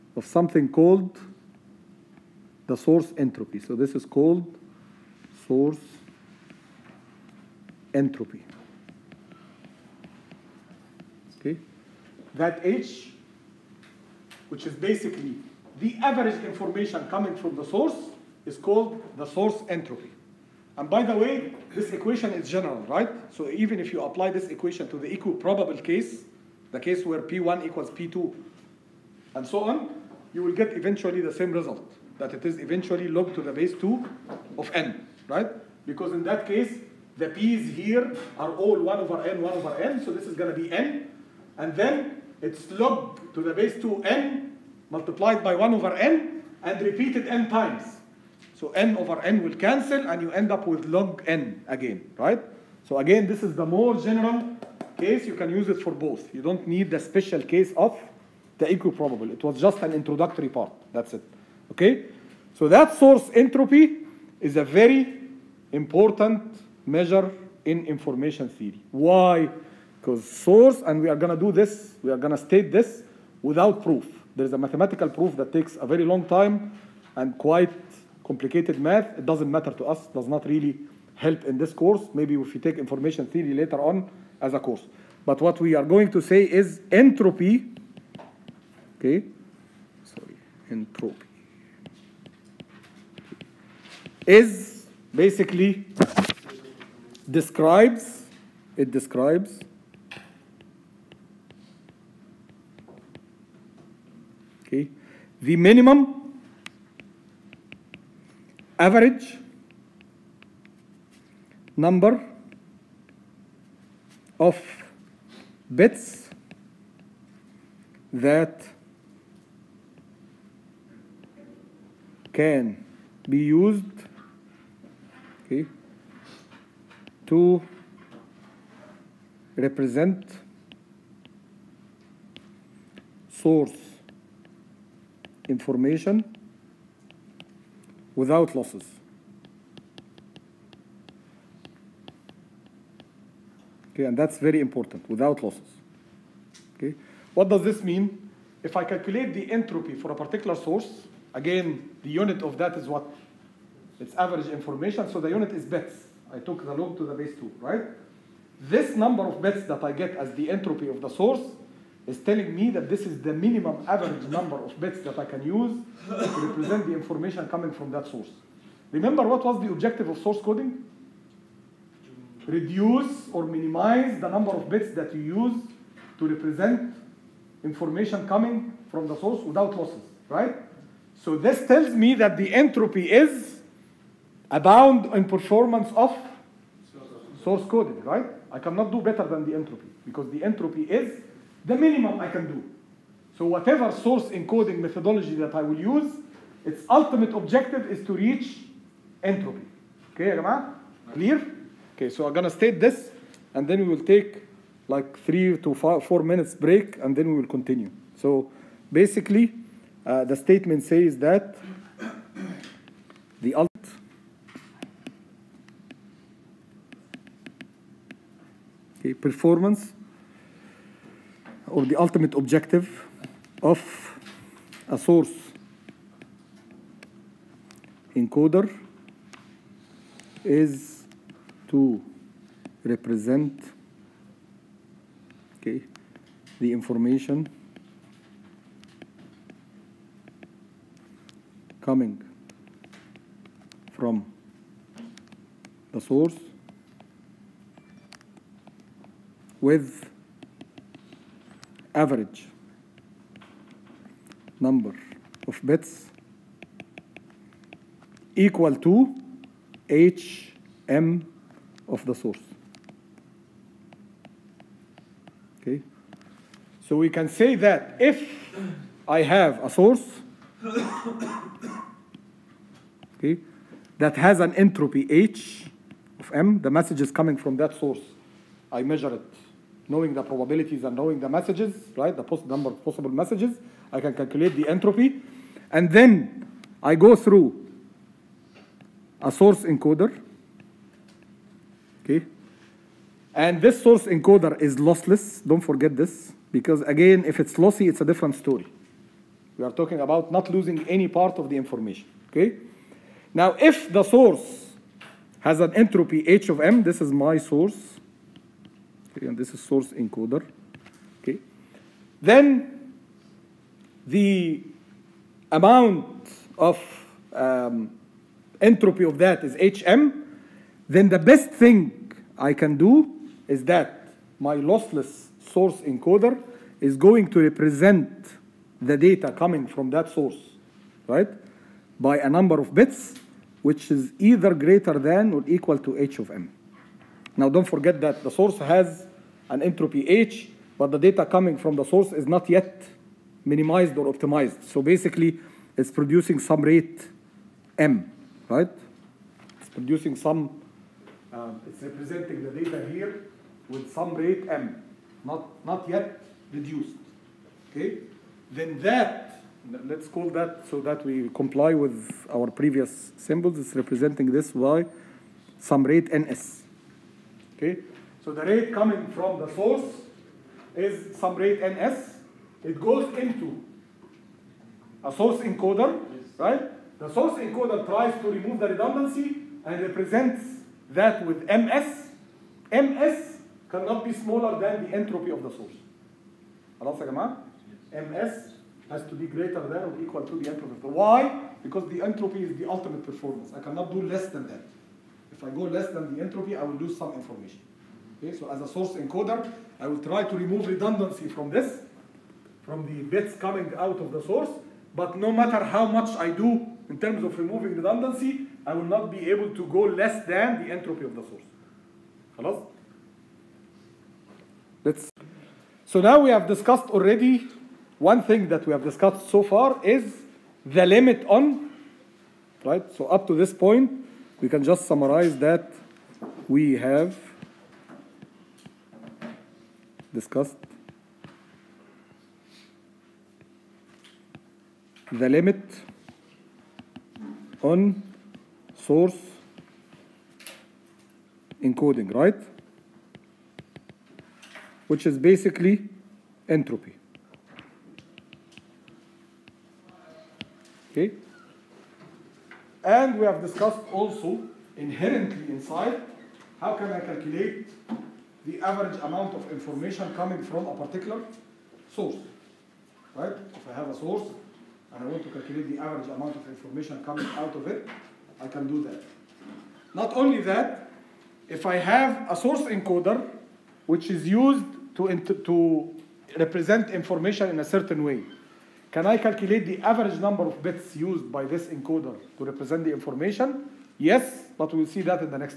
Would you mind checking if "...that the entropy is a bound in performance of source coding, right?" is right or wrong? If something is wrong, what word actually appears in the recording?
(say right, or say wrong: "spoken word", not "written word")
right.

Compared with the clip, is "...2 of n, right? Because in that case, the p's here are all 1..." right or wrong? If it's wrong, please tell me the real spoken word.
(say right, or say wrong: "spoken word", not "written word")
right.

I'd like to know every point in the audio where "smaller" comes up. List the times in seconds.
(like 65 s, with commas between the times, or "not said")
384 s.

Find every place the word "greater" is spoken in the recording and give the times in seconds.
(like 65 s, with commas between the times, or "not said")
334 s, 389 s.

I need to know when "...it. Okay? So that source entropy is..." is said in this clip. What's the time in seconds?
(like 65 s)
61 s.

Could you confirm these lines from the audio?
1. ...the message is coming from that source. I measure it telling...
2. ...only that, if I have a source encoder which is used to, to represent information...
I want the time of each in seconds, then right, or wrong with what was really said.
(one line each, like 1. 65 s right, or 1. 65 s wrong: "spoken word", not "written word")
1. 276 s wrong: "knowing", not "telling"
2. 470 s right.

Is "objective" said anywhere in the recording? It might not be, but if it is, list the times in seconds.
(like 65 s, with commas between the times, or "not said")
169 s, 197 s, 222 s.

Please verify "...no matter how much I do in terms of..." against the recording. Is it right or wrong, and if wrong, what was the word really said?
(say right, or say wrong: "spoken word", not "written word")
right.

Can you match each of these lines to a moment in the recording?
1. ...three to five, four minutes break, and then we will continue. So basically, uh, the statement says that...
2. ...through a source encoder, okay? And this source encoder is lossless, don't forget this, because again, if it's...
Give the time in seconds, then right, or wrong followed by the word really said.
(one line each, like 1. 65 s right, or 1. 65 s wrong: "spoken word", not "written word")
1. 205 s right
2. 287 s right.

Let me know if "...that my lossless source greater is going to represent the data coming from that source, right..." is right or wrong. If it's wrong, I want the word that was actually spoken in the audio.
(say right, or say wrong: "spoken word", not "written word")
wrong: "encoder", not "greater".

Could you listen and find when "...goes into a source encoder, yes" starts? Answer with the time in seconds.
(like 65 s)
372 s.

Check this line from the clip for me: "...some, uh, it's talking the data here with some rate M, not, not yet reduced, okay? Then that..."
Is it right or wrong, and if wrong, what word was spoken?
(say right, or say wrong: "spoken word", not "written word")
wrong: "representing", not "talking".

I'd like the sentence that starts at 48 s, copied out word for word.
So n over n will cancel and you end up with log n again, right?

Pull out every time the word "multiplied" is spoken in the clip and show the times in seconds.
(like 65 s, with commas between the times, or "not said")
44 s.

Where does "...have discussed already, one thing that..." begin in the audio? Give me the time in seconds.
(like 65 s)
416 s.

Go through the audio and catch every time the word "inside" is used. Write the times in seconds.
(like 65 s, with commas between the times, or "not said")
455 s.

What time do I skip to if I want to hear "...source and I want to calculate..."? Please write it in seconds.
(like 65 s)
463 s.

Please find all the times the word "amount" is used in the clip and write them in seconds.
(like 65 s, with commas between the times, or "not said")
315 s, 459 s, 466 s.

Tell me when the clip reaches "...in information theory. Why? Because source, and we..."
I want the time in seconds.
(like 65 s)
67 s.